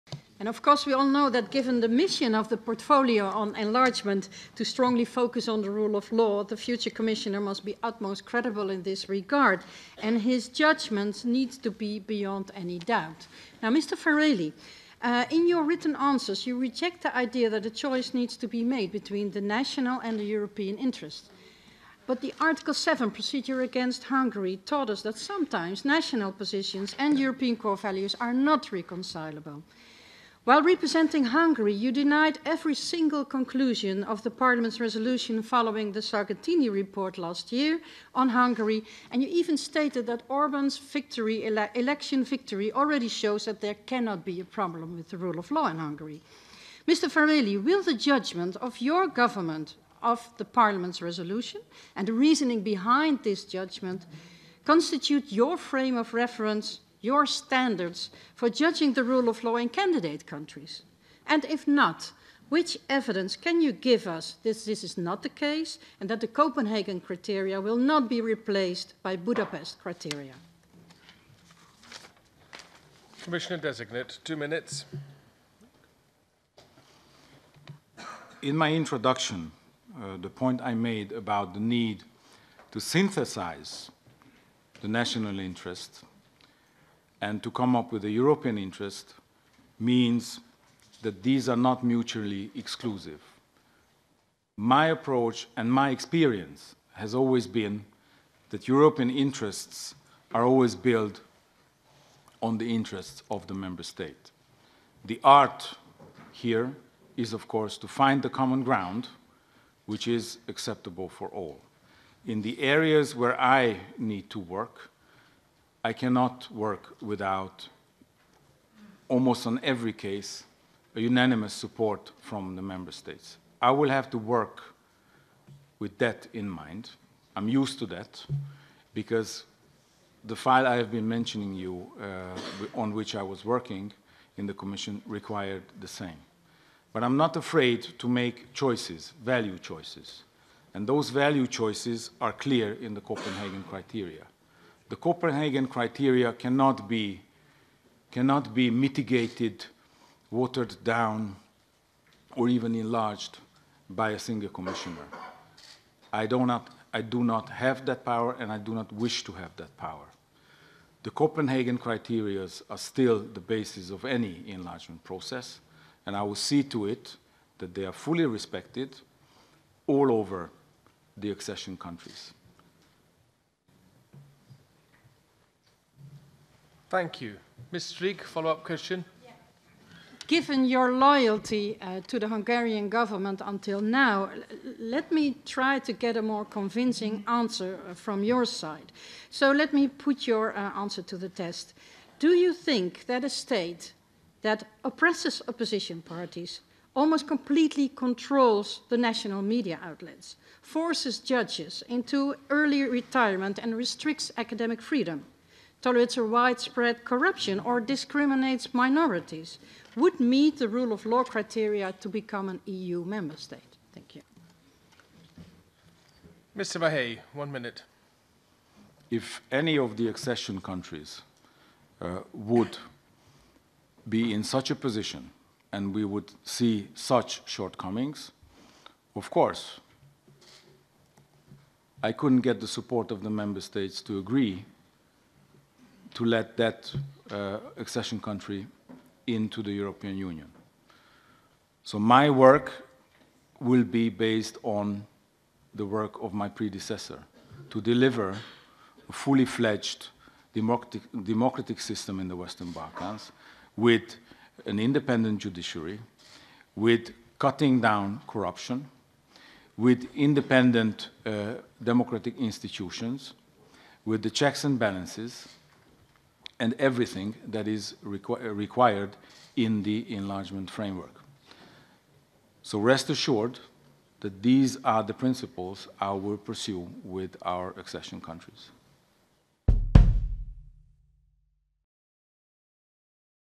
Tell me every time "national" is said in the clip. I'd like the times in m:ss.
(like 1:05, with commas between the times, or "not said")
0:19, 0:25, 1:24, 3:18.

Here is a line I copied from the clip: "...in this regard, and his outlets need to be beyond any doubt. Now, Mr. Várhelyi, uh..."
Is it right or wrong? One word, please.
wrong.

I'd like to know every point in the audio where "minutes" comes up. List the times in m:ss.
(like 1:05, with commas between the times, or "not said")
1:14, 3:37.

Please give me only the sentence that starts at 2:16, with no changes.
But I'm not afraid to make choices, value choices.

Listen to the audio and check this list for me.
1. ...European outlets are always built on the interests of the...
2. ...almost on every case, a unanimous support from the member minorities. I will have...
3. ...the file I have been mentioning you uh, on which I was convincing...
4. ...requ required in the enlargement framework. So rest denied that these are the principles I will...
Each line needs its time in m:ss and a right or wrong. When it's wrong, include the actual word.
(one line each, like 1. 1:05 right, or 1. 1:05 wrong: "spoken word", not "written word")
1. 1:38 wrong: "interests", not "outlets"
2. 1:59 wrong: "states", not "minorities"
3. 2:10 wrong: "working", not "convincing"
4. 4:28 wrong: "assured", not "denied".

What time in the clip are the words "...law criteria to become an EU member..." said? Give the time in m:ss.
3:31.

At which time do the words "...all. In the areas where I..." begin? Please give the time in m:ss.
1:51.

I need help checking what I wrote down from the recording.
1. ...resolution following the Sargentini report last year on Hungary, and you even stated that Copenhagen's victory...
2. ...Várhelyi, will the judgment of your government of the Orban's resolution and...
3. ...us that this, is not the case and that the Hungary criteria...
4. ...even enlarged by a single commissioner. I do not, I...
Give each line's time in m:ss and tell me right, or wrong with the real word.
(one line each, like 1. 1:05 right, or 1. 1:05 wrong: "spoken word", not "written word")
1. 0:34 wrong: "Orban", not "Copenhagen"
2. 0:47 wrong: "Parliament", not "Orban"
3. 1:04 wrong: "Copenhagen", not "Hungary"
4. 2:32 right.